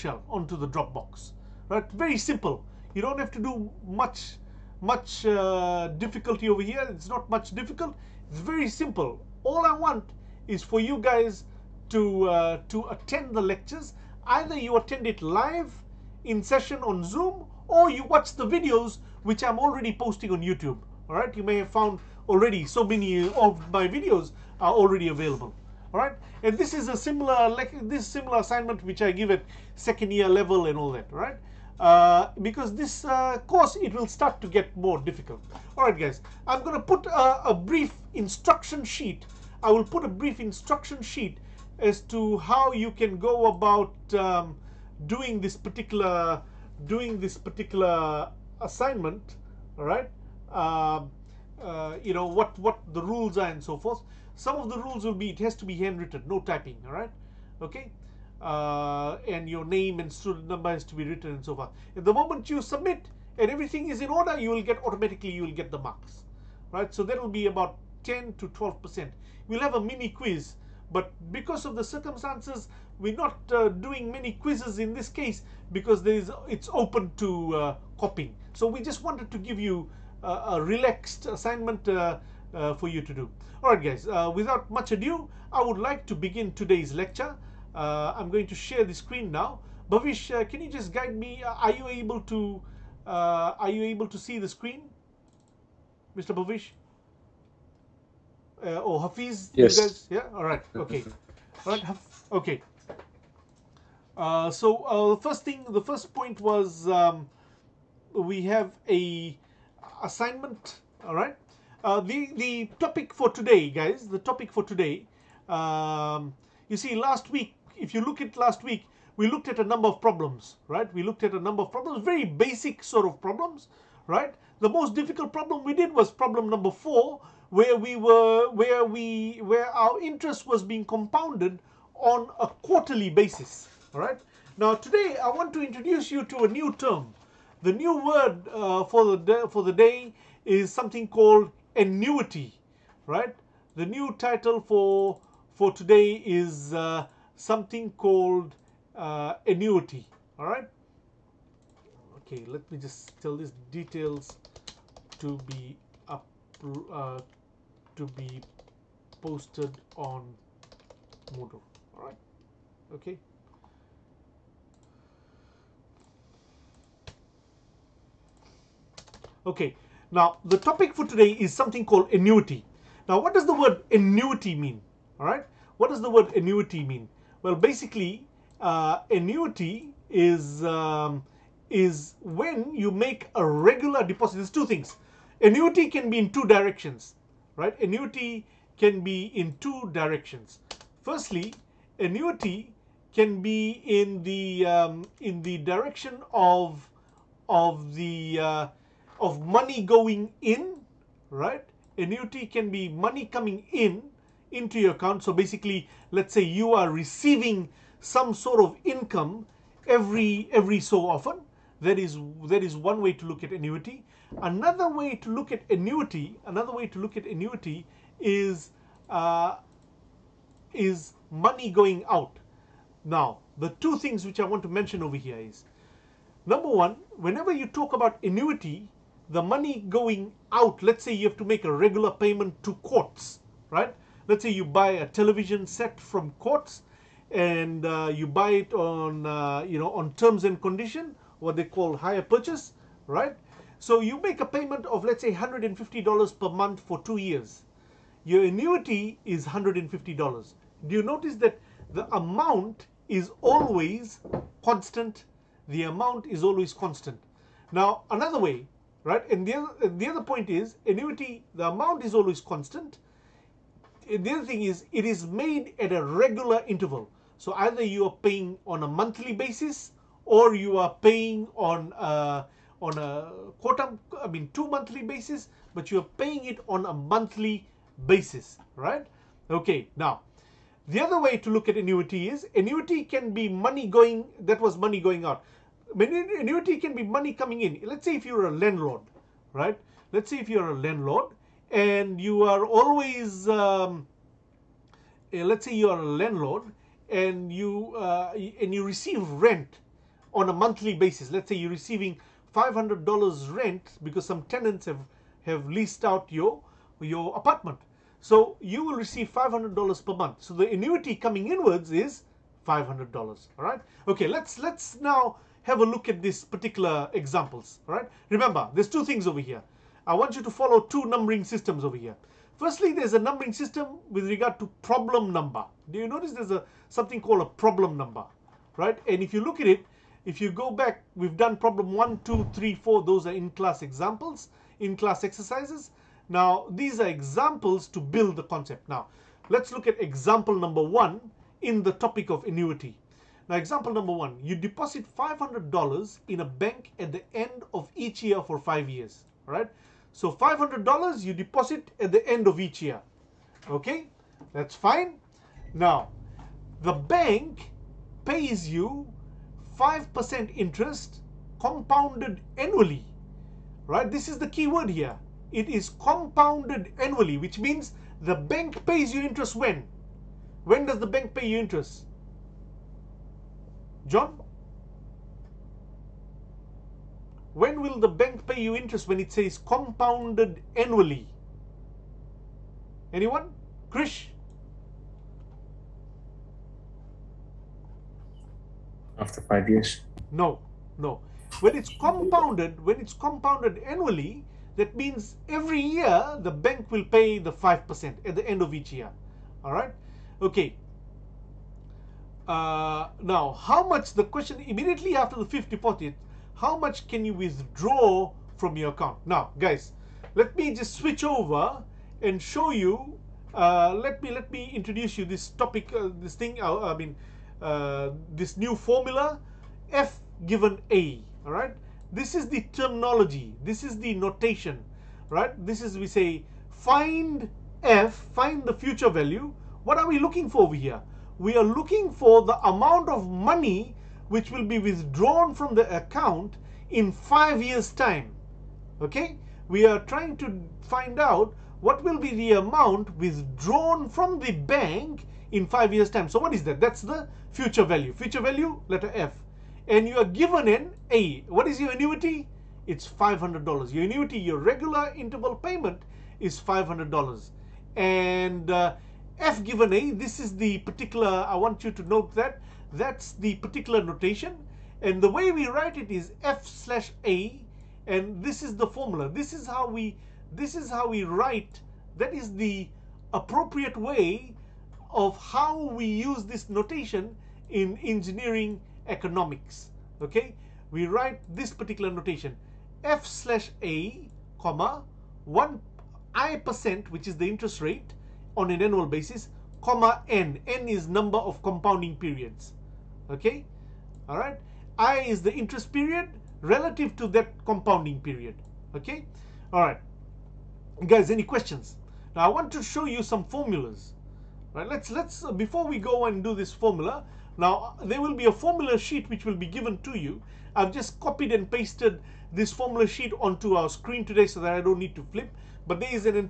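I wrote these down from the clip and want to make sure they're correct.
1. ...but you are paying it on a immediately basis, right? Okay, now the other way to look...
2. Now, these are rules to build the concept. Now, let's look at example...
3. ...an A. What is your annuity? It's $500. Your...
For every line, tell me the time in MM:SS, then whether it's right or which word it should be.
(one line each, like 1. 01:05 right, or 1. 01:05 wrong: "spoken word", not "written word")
1. 04:35 wrong: "monthly", not "immediately"
2. 05:36 wrong: "examples", not "rules"
3. 07:30 right.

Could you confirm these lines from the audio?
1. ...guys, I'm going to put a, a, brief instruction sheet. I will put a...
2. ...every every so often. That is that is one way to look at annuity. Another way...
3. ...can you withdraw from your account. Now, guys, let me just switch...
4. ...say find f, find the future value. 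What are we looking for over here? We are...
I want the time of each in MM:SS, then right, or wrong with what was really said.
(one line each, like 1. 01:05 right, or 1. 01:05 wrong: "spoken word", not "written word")
1. 00:35 right
2. 03:29 right
3. 06:47 right
4. 07:06 right.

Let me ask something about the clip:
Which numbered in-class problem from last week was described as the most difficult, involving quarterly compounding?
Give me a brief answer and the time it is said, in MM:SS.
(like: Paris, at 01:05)
Problem 4, at 02:06.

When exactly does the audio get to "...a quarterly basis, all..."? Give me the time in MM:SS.
02:12.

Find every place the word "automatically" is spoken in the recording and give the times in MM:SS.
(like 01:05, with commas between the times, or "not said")
01:04.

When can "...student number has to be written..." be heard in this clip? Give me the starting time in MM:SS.
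01:00.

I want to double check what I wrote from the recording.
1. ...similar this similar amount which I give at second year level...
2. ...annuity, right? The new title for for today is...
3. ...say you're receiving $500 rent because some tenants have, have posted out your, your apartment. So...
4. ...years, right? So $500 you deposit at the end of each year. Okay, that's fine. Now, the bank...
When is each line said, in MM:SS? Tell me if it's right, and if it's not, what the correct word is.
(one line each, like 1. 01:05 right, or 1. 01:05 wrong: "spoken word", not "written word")
1. 00:26 wrong: "assignment", not "amount"
2. 02:21 right
3. 05:01 wrong: "leased", not "posted"
4. 05:48 right.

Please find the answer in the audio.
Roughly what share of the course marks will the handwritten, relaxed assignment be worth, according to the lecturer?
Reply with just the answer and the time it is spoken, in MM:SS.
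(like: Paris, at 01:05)
10 to 12 percent, at 01:08.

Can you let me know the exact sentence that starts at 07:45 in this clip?
And the way we write it is f slash a, and this is the formula.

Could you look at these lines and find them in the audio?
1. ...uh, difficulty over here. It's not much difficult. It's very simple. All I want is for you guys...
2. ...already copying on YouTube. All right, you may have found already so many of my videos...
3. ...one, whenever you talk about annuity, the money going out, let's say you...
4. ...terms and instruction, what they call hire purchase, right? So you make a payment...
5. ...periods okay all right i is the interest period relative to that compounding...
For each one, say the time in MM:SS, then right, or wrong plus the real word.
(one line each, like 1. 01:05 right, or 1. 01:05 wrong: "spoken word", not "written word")
1. 00:05 right
2. 00:19 wrong: "posting", not "copying"
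3. 03:46 right
4. 04:00 wrong: "condition", not "instruction"
5. 08:12 right.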